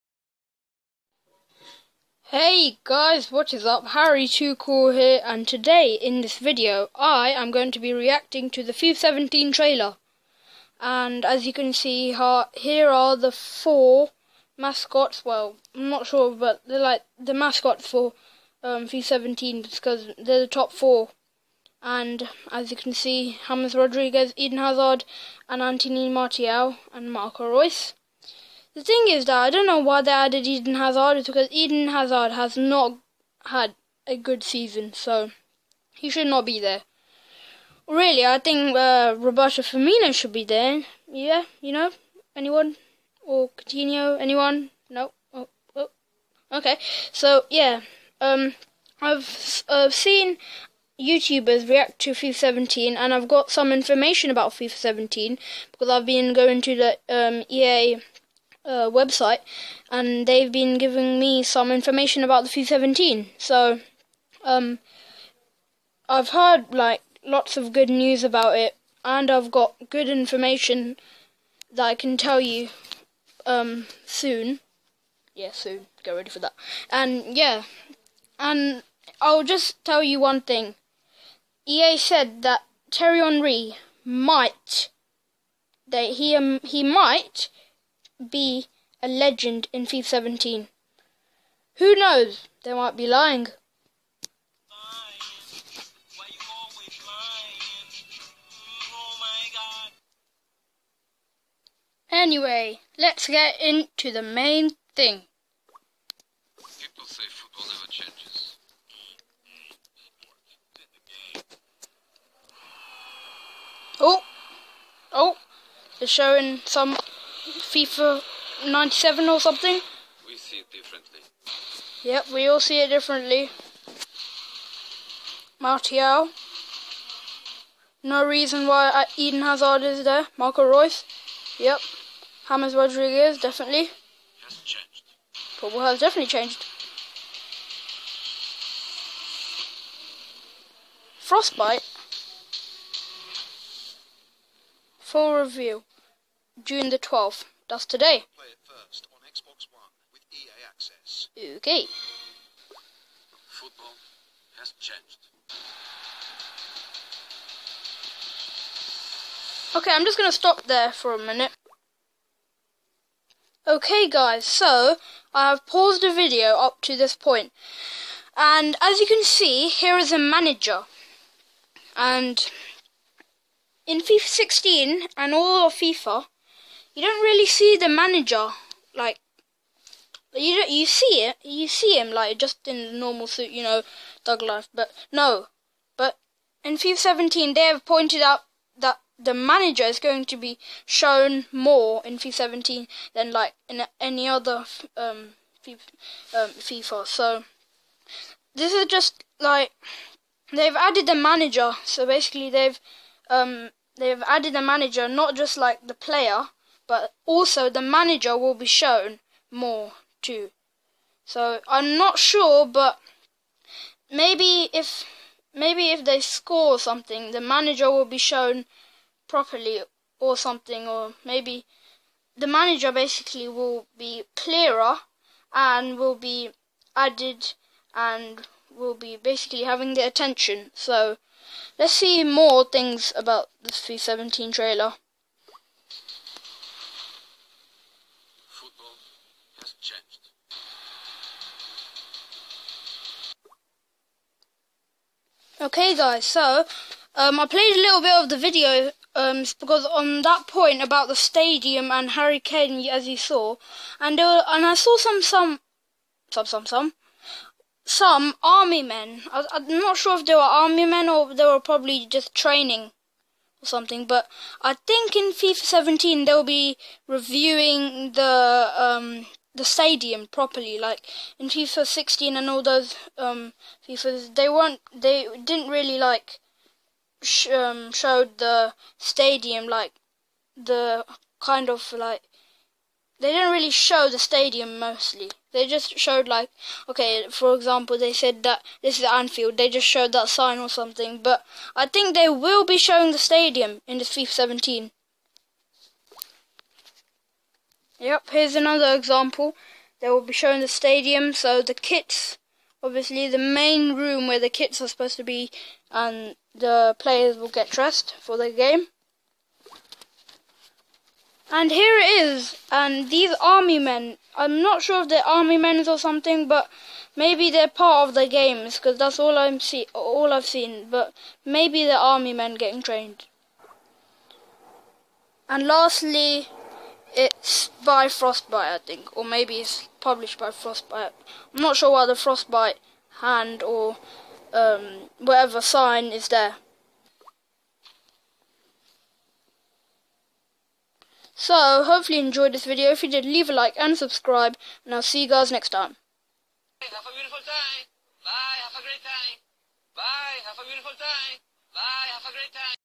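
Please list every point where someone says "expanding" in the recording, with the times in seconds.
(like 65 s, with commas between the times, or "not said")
not said.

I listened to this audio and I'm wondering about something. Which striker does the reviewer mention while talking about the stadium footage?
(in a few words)
Harry Kane.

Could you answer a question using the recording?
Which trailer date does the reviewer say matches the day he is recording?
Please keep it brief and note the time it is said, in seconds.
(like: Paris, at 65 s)
June 12, at 146 s.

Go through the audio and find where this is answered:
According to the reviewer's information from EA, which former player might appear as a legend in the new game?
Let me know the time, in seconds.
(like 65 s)
82 s.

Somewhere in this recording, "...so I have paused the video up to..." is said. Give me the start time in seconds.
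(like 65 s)
164 s.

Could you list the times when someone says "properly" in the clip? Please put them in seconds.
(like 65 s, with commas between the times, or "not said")
219 s, 270 s.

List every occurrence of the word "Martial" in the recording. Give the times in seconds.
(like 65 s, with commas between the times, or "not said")
26 s, 125 s.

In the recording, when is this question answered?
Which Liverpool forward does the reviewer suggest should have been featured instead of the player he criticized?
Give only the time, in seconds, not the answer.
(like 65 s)
39 s.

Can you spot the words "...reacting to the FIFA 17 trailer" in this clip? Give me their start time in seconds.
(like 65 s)
7 s.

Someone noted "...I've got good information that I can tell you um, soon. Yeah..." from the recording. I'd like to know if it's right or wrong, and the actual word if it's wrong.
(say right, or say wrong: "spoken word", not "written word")
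right.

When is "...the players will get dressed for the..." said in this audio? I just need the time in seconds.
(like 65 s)
306 s.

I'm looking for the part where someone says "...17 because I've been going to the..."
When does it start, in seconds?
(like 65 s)
54 s.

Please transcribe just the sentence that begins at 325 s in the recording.
And lastly, it's by Frostbite, I think, or maybe it's published by Frostbite.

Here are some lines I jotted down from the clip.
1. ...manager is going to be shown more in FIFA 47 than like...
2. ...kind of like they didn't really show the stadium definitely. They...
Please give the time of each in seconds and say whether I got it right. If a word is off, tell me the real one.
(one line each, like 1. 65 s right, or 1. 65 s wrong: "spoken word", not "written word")
1. 189 s wrong: "17", not "47"
2. 281 s wrong: "mostly", not "definitely".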